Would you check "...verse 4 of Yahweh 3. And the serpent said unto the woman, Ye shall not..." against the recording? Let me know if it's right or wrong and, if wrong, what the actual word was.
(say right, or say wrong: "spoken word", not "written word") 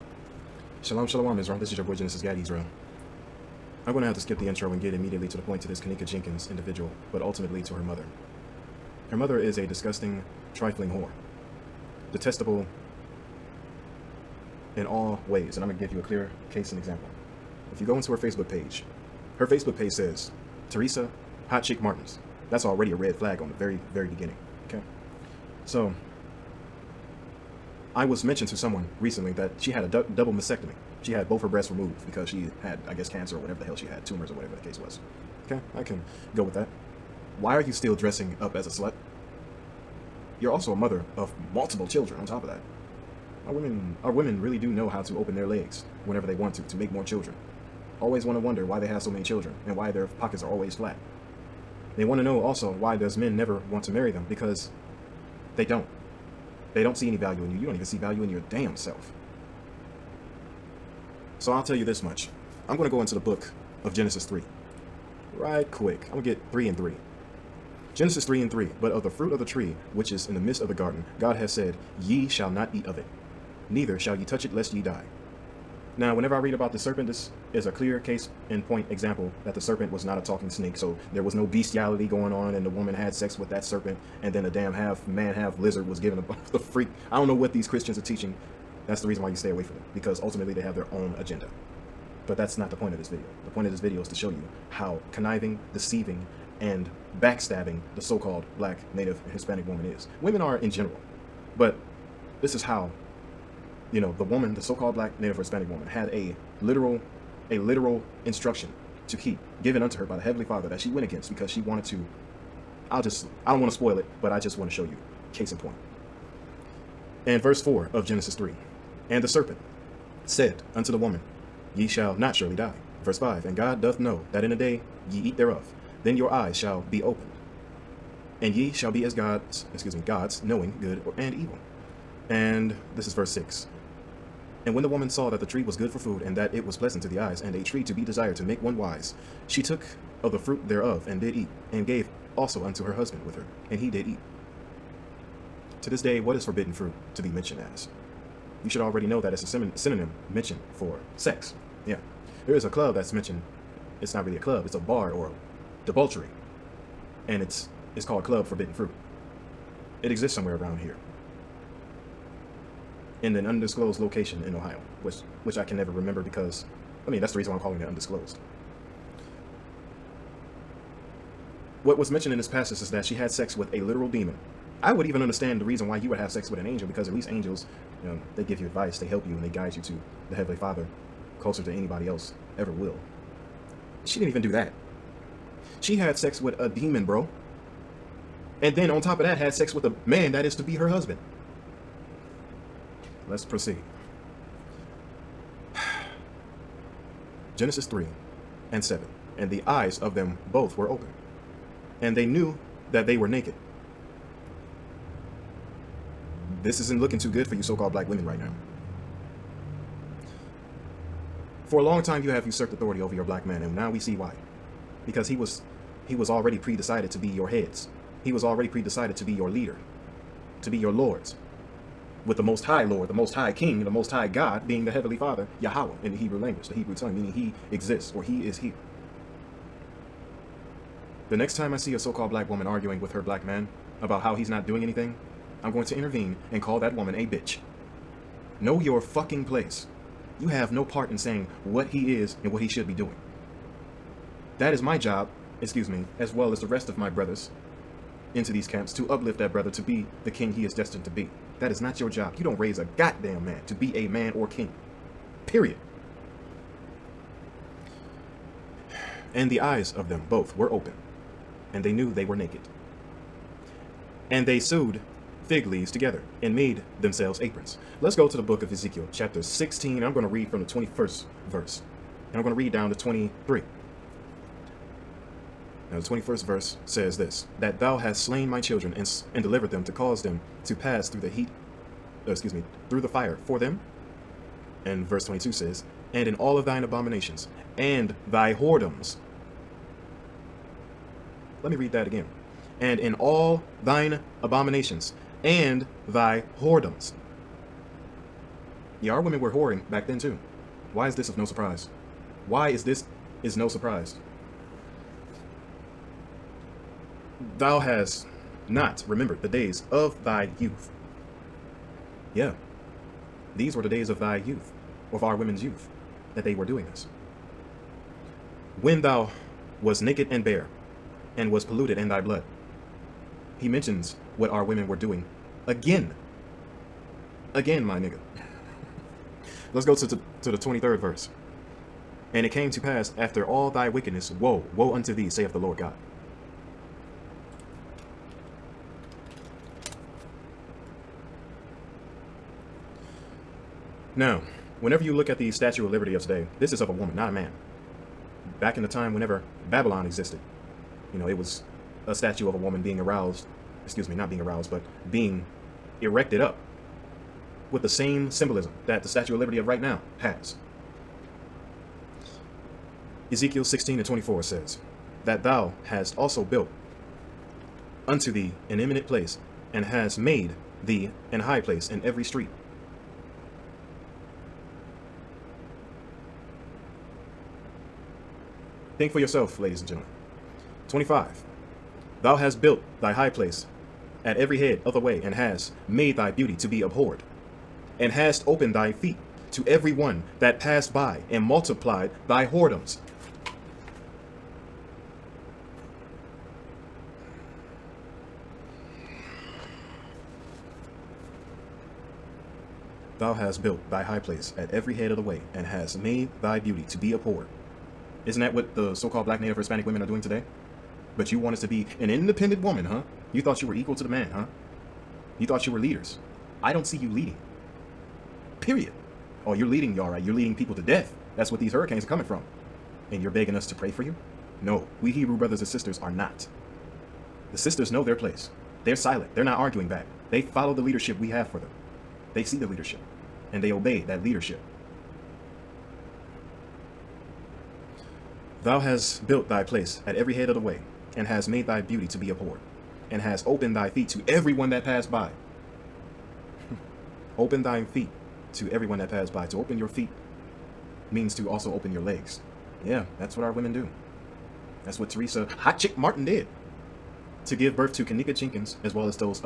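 wrong: "Genesis", not "Yahweh".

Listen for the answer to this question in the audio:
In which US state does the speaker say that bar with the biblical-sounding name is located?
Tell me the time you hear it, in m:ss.
2:44.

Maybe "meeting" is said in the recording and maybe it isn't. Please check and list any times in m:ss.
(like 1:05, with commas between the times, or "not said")
not said.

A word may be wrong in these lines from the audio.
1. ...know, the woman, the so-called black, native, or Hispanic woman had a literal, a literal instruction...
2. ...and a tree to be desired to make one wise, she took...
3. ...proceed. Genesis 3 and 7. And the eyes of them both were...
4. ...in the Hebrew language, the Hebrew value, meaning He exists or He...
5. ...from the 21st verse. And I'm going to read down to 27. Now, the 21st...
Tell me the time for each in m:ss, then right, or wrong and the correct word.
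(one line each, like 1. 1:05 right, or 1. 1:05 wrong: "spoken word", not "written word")
1. 1:43 right
2. 2:17 right
3. 3:13 right
4. 3:46 wrong: "tongue", not "value"
5. 4:30 wrong: "23", not "27".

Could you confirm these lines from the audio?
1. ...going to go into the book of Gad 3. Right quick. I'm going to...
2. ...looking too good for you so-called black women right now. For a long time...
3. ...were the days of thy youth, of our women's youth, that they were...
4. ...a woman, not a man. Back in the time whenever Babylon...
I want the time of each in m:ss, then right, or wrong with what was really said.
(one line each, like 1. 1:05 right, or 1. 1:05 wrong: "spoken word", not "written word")
1. 1:02 wrong: "Genesis", not "Gad"
2. 3:27 right
3. 5:13 right
4. 5:46 right.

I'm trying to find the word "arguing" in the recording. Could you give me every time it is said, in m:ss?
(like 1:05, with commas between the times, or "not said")
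3:52, 7:09.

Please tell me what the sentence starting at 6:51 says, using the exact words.
But you wanted to be an independent woman, huh?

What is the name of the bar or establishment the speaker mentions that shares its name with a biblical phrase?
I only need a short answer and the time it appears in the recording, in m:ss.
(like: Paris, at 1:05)
Club Forbidden Fruit, at 2:38.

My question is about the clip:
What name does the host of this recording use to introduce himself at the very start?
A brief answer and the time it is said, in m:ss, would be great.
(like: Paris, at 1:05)
Genesis Gad Yisrael, at 0:01.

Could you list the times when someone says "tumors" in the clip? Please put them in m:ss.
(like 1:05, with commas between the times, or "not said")
0:34.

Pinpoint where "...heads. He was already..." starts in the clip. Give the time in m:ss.
3:37.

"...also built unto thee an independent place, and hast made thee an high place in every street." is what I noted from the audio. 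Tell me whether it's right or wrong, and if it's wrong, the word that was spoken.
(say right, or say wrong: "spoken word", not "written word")
wrong: "eminent", not "independent".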